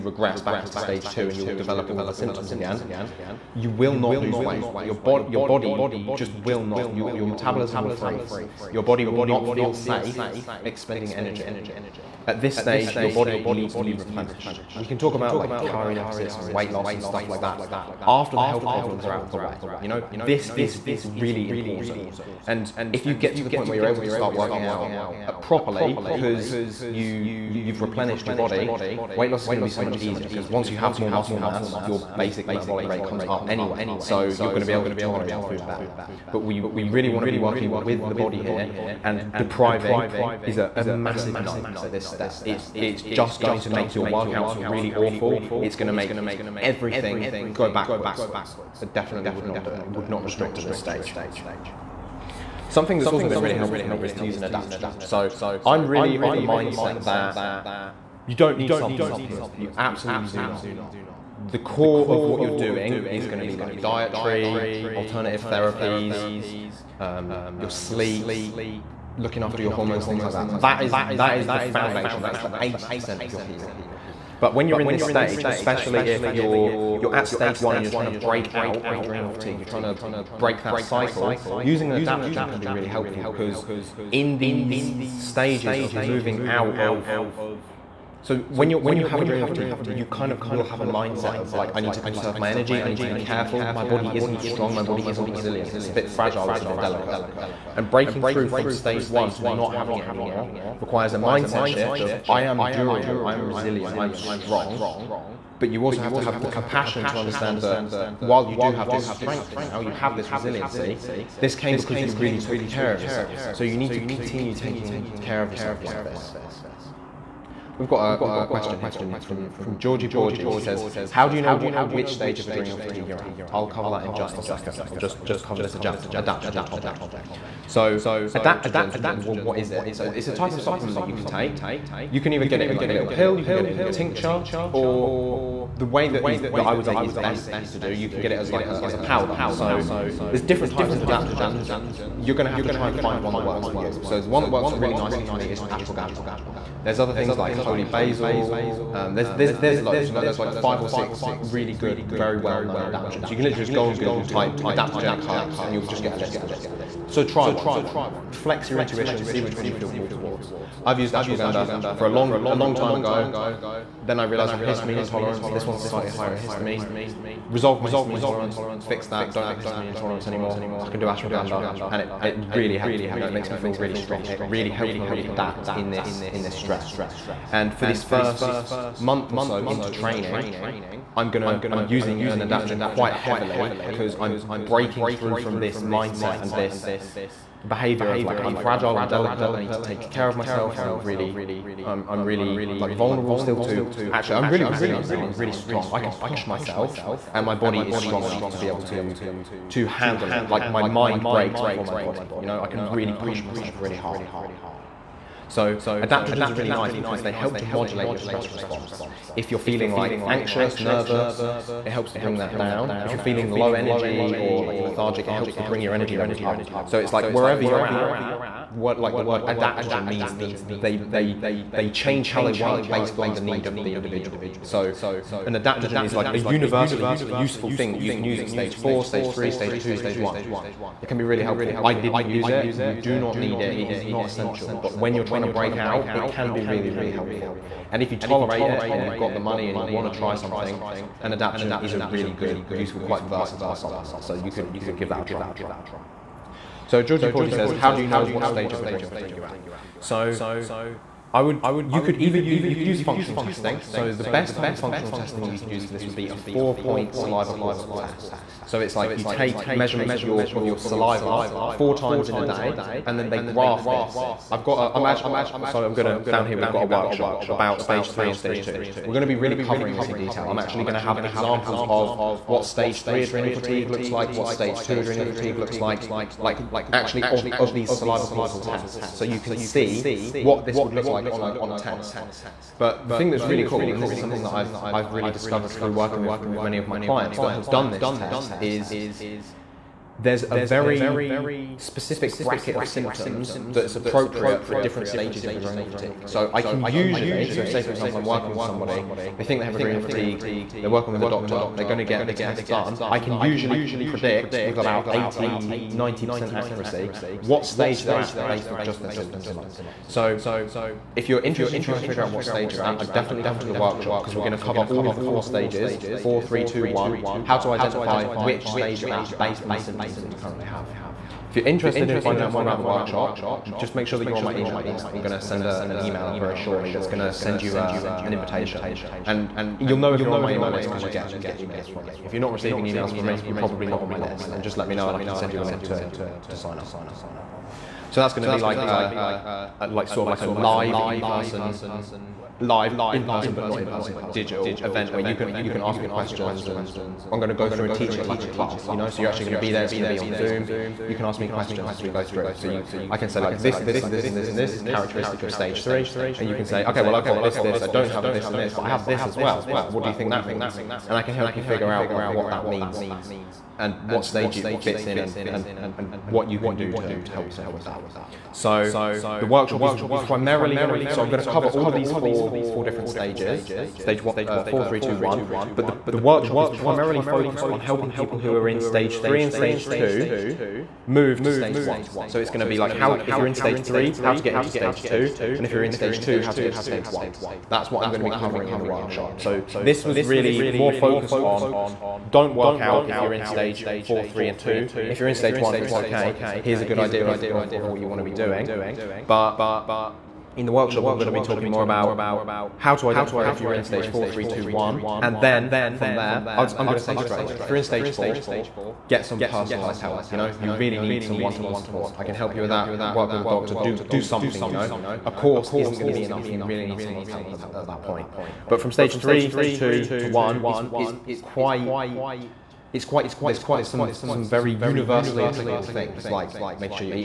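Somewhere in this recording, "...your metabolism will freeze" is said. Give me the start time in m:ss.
0:07.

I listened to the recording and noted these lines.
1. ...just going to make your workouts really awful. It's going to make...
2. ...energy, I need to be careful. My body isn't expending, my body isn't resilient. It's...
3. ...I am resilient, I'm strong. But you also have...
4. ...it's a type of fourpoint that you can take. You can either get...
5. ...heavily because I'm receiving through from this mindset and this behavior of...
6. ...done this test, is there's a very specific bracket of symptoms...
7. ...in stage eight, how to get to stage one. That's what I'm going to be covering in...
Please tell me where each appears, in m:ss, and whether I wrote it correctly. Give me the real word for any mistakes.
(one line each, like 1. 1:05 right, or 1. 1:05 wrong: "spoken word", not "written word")
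1. 0:43 right
2. 1:32 wrong: "strong", not "expending"
3. 1:43 right
4. 2:10 wrong: "supplement", not "fourpoint"
5. 3:03 wrong: "breaking", not "receiving"
6. 4:47 right
7. 6:25 wrong: "two", not "eight".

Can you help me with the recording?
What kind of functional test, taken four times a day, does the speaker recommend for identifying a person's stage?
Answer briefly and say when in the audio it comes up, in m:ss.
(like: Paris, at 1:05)
Four-point saliva cortisol test, at 4:16.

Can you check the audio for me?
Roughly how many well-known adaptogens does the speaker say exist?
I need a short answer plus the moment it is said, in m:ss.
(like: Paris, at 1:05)
5 or 6, at 2:30.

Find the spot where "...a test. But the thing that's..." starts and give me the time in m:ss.
4:41.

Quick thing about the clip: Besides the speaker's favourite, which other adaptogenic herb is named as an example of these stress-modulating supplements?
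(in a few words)
Holy basil.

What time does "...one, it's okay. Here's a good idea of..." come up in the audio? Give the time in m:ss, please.
6:35.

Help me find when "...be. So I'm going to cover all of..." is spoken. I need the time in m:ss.
6:10.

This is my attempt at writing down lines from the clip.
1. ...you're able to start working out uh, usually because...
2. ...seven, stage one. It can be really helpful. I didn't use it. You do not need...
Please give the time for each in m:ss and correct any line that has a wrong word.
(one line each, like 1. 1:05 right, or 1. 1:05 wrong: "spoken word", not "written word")
1. 0:23 wrong: "properly", not "usually"
2. 3:49 wrong: "two", not "seven".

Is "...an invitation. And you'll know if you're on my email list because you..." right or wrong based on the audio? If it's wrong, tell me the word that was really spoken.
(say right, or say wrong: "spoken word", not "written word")
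right.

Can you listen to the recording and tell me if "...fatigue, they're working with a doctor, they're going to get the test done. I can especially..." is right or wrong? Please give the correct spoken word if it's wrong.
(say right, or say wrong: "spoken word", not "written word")
wrong: "usually", not "especially".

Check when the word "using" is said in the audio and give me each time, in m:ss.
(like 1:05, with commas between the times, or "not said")
1:21, 3:01.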